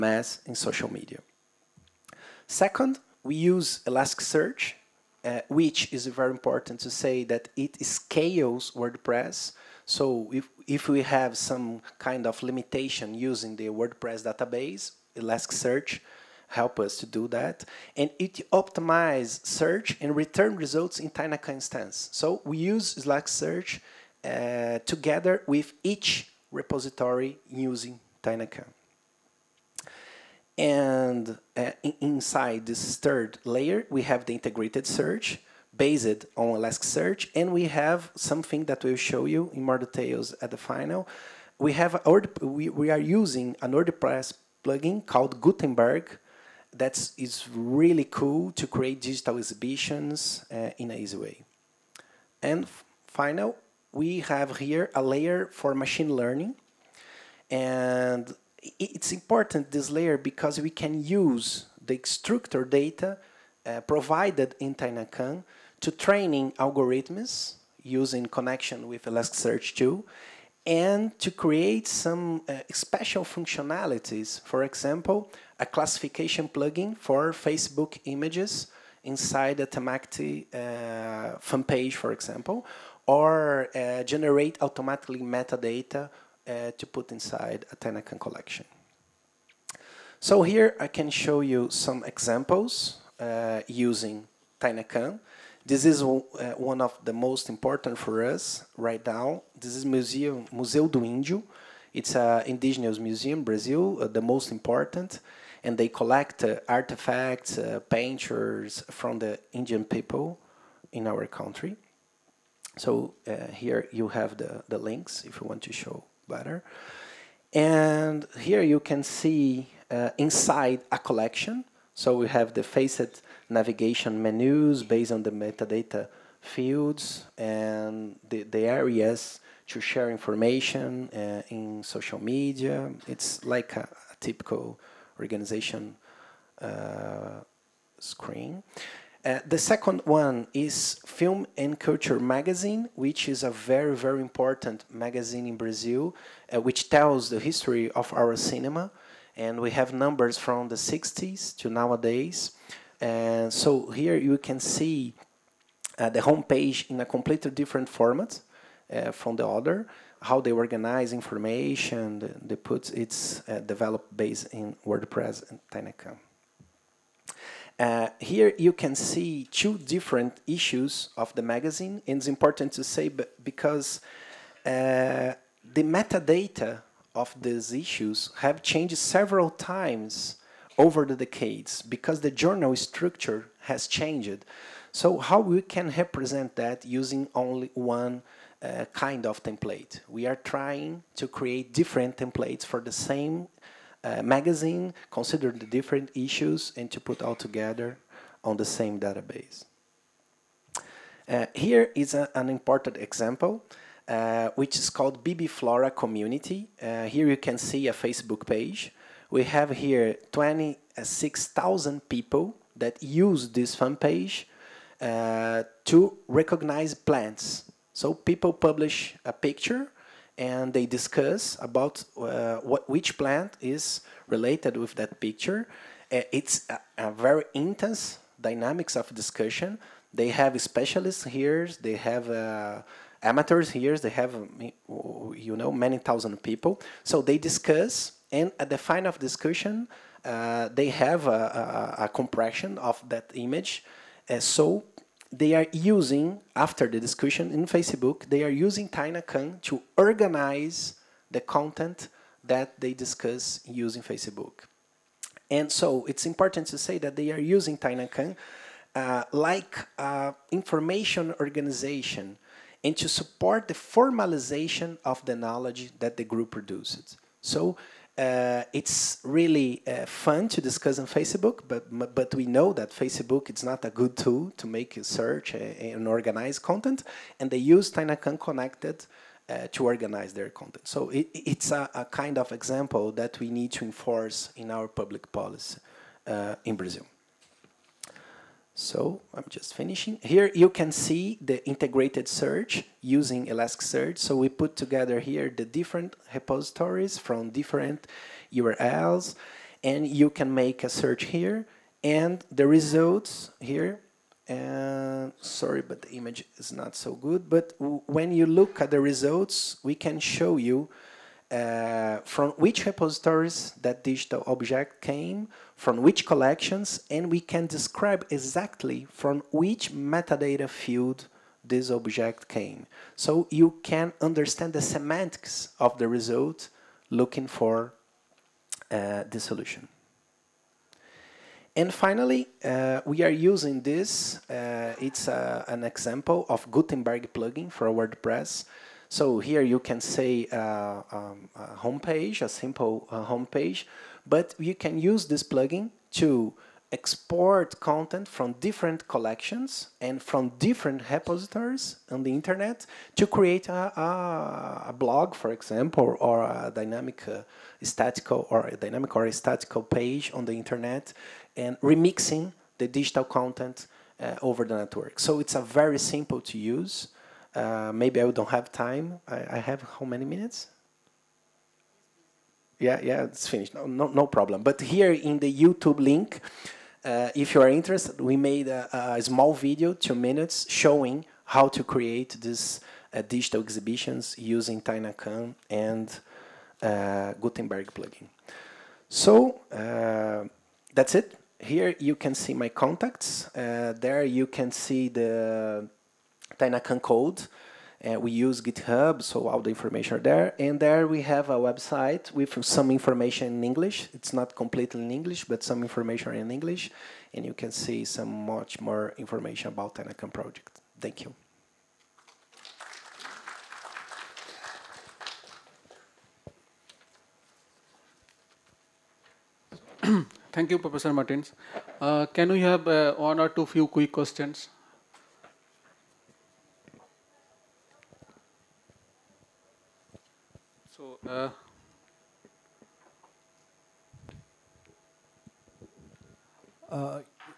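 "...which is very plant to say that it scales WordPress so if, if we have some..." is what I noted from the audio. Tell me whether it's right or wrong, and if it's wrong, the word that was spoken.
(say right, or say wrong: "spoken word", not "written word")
wrong: "important", not "plant".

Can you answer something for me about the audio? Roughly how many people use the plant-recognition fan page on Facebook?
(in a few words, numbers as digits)
26,000.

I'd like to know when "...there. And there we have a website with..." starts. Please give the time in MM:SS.
06:40.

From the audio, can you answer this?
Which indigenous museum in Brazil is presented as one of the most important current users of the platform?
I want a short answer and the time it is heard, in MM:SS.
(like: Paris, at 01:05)
Museu do Índio, at 01:40.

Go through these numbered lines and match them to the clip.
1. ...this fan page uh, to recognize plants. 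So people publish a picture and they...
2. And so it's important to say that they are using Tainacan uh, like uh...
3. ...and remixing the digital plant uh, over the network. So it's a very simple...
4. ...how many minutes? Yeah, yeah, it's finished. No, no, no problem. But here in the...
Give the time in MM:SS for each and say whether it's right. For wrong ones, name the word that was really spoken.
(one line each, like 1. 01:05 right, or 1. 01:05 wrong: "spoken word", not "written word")
1. 03:33 right
2. 04:15 right
3. 06:01 wrong: "content", not "plant"
4. 06:09 right.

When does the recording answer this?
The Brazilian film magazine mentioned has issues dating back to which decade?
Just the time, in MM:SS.
02:30.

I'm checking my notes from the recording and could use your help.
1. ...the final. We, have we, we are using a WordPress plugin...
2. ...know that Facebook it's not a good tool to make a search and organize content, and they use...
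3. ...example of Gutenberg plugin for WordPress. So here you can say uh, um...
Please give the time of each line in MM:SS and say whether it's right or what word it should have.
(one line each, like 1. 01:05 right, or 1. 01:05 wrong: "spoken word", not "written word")
1. 00:40 right
2. 04:32 right
3. 05:35 right.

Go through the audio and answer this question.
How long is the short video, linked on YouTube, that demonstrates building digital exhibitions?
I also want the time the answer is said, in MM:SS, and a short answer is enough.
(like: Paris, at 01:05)
2 minutes, at 06:19.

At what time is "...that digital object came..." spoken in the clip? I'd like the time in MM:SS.
05:13.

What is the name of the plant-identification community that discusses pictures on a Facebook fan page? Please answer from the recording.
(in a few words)
BB Flora.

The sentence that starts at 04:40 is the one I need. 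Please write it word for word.
So it, it's a, a, kind of example that we need to enforce in our public policy uh, in Brazil.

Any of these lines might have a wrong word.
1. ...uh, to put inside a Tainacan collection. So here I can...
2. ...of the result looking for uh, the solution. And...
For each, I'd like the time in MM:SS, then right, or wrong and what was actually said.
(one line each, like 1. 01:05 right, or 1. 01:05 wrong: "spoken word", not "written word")
1. 01:26 right
2. 05:25 right.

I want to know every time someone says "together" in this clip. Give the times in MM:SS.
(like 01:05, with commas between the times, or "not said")
00:24, 03:17, 04:54.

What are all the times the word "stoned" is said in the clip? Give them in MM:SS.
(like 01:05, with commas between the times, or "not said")
not said.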